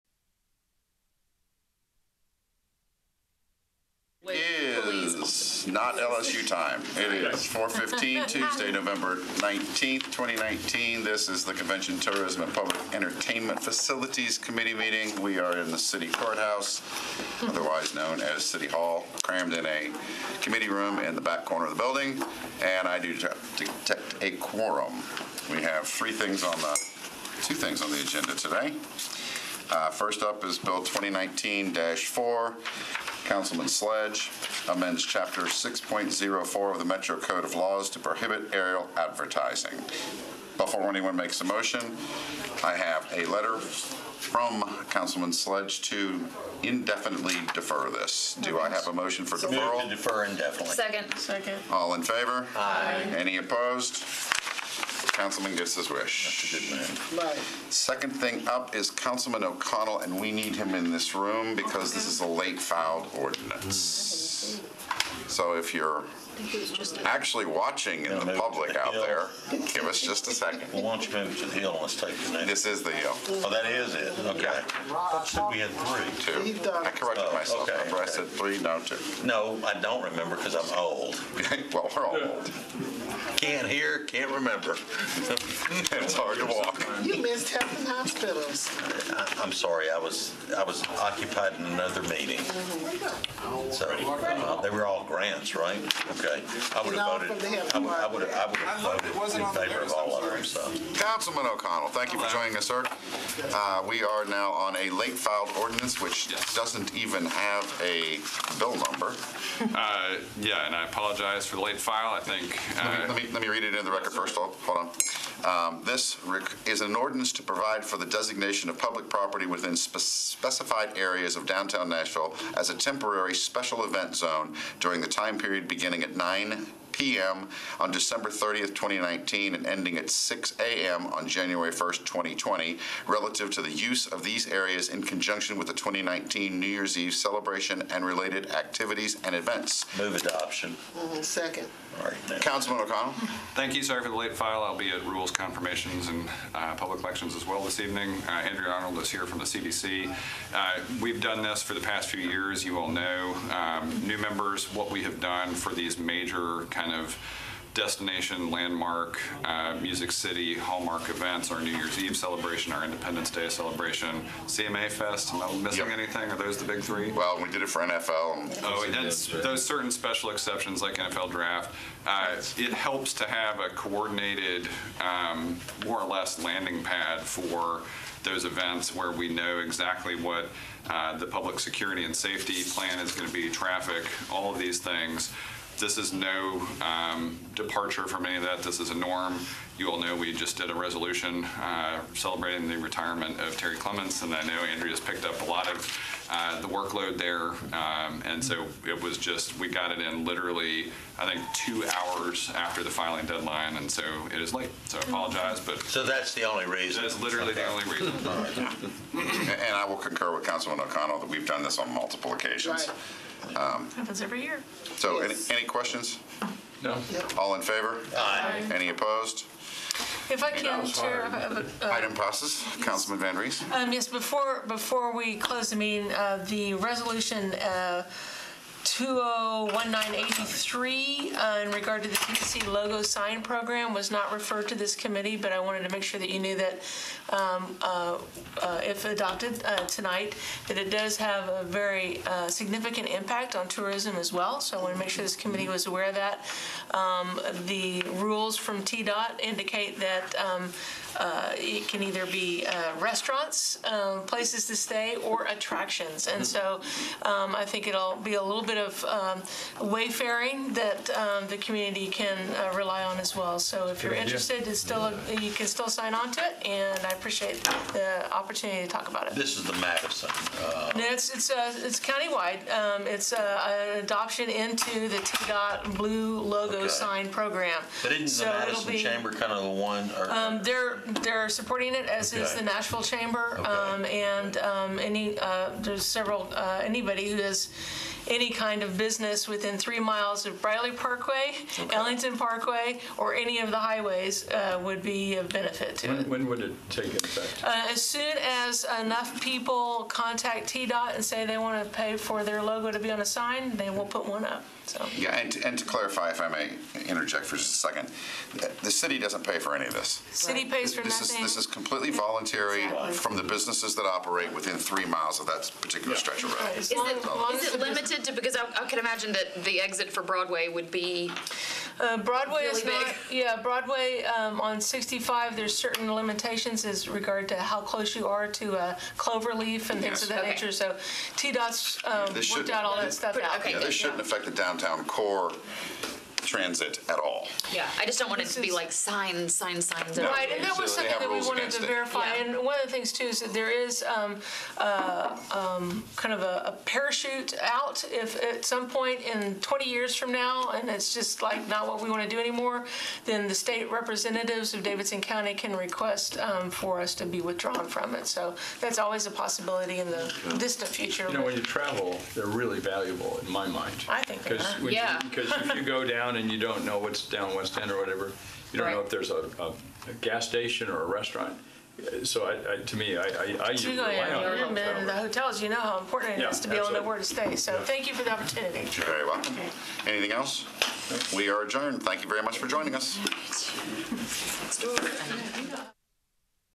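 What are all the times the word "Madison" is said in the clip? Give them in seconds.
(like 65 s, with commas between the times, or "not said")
269 s, 278 s.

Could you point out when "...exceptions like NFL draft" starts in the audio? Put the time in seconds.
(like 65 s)
170 s.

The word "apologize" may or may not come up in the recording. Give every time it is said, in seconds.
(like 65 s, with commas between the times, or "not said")
110 s, 205 s.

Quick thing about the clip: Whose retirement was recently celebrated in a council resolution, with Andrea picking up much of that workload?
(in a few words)
Terry Clements.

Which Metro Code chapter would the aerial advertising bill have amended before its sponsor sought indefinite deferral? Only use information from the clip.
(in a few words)
Chapter 6.04.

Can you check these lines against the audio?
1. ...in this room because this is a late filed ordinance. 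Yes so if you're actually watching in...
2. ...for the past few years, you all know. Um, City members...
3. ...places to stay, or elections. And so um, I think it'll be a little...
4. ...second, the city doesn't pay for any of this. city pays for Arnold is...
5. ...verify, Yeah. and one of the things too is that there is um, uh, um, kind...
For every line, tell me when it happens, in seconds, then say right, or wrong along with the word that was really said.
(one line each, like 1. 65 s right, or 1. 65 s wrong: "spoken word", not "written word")
1. 60 s right
2. 151 s wrong: "New", not "City"
3. 254 s wrong: "attractions", not "elections"
4. 307 s wrong: "This", not "Arnold"
5. 341 s right.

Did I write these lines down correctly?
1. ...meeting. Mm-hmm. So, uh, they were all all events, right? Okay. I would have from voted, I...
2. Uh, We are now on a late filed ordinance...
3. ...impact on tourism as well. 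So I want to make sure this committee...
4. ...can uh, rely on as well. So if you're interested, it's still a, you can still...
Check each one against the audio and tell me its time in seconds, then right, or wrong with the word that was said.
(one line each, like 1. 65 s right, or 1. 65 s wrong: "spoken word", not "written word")
1. 92 s wrong: "grants", not "events"
2. 103 s right
3. 243 s right
4. 262 s right.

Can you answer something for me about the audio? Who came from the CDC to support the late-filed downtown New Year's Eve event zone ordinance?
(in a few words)
Andrew Arnold.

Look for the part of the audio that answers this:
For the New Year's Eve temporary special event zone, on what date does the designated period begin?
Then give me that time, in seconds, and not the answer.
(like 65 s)
127 s.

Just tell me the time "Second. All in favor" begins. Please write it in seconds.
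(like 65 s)
51 s.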